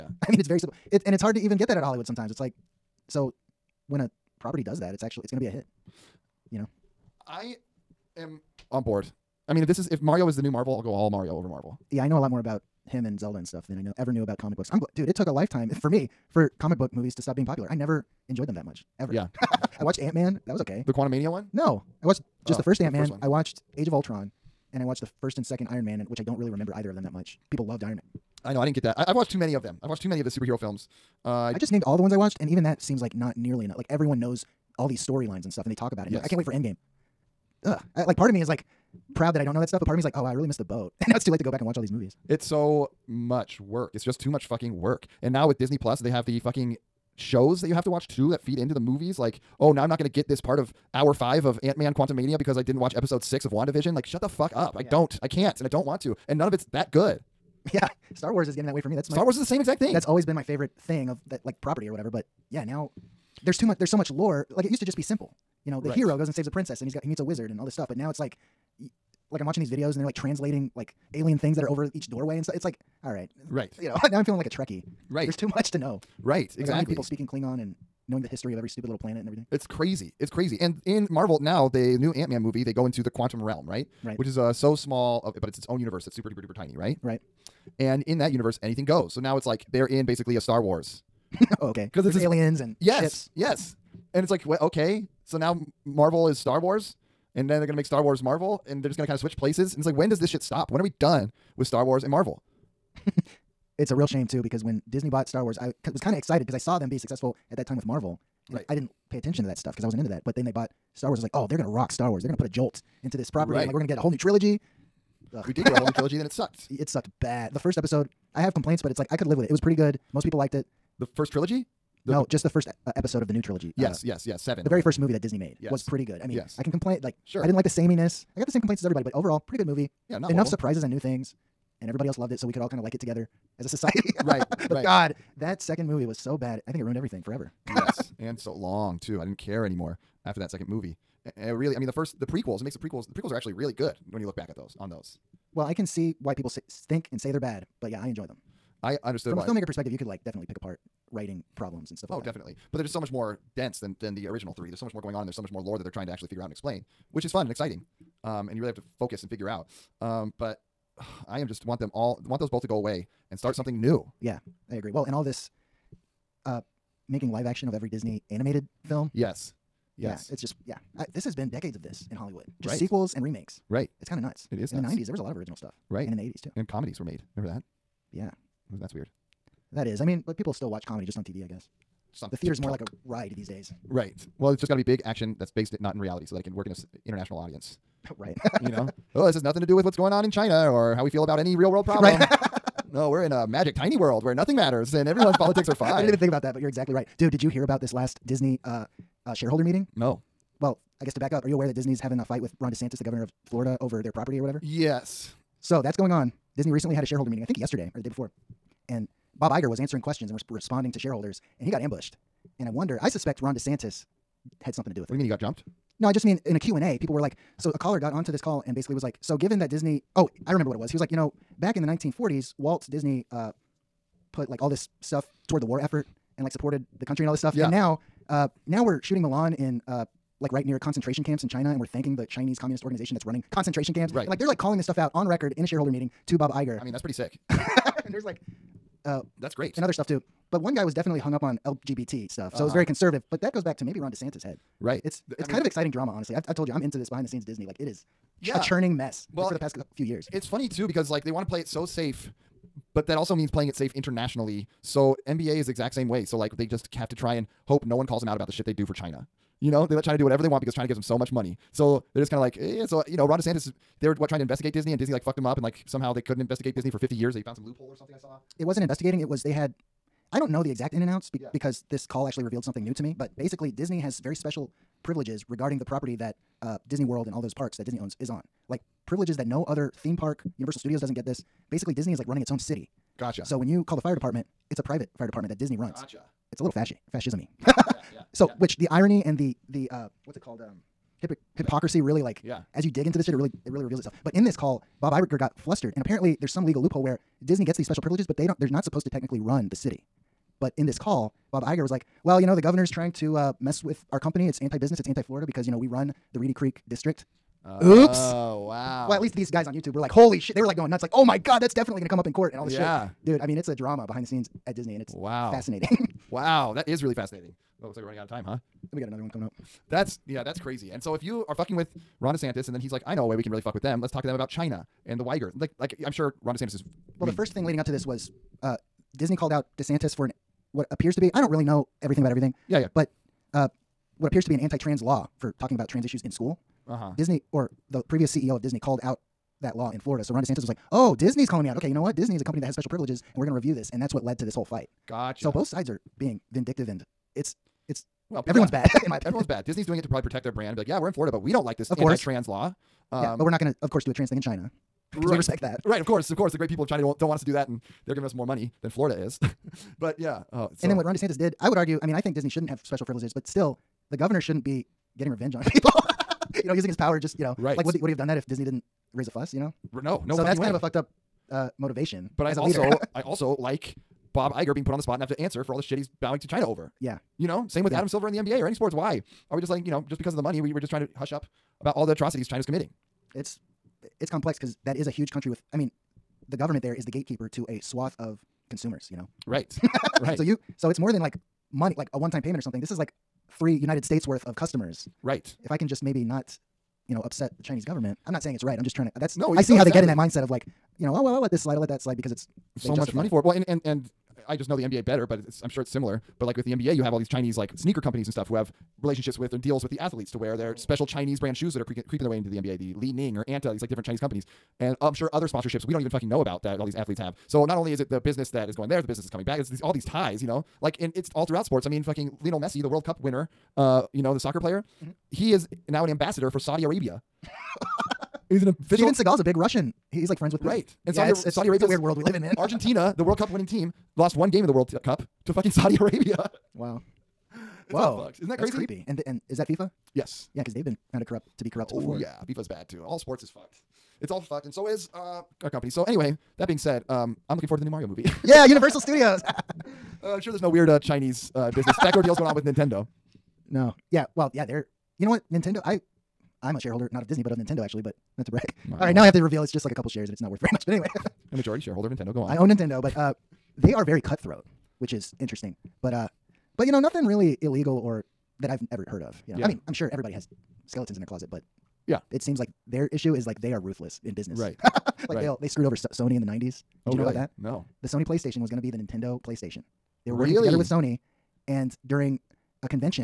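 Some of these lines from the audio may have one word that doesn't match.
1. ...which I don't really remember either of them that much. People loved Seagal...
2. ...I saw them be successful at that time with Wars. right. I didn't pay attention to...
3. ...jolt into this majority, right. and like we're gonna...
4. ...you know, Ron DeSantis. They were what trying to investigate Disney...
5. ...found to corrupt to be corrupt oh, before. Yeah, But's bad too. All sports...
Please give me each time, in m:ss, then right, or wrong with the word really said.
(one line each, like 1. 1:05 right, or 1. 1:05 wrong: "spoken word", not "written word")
1. 0:26 wrong: "Iron", not "Seagal"
2. 1:46 wrong: "Marvel", not "Wars"
3. 1:52 wrong: "property", not "majority"
4. 4:23 right
5. 7:21 wrong: "FIFA", not "But".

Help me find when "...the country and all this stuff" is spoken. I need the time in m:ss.
3:47.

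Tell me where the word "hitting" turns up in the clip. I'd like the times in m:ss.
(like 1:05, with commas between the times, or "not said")
not said.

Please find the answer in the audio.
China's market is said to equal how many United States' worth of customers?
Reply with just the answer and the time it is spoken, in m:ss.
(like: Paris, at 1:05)
3, at 6:33.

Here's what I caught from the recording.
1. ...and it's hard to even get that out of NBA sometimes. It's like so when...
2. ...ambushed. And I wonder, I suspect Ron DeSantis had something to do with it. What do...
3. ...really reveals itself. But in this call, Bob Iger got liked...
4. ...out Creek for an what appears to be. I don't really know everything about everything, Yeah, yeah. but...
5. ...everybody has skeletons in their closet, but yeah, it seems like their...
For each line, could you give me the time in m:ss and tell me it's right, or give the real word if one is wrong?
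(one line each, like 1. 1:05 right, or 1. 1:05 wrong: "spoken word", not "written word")
1. 0:01 wrong: "Hollywood", not "NBA"
2. 3:31 right
3. 4:53 wrong: "flustered", not "liked"
4. 5:29 wrong: "DeSantis", not "Creek"
5. 7:50 right.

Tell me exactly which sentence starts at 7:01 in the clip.
I mean, fucking Lionel Messi, the World Cup winner, uh, you know, the soccer player.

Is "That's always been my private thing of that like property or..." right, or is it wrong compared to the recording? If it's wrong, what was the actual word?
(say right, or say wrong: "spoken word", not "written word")
wrong: "favorite", not "private".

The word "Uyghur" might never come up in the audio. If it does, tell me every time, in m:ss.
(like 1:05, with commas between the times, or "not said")
5:25.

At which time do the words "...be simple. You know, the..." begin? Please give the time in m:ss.
1:04.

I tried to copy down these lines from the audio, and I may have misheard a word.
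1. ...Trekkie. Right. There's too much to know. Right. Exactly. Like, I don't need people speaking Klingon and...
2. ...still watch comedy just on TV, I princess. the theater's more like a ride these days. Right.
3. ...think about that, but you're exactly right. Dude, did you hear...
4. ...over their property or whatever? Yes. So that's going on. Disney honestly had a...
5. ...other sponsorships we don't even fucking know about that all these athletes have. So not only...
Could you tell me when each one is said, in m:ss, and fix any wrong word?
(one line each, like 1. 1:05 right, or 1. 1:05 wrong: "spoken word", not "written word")
1. 1:14 right
2. 3:00 wrong: "guess", not "princess"
3. 3:16 right
4. 3:23 wrong: "recently", not "honestly"
5. 6:55 right.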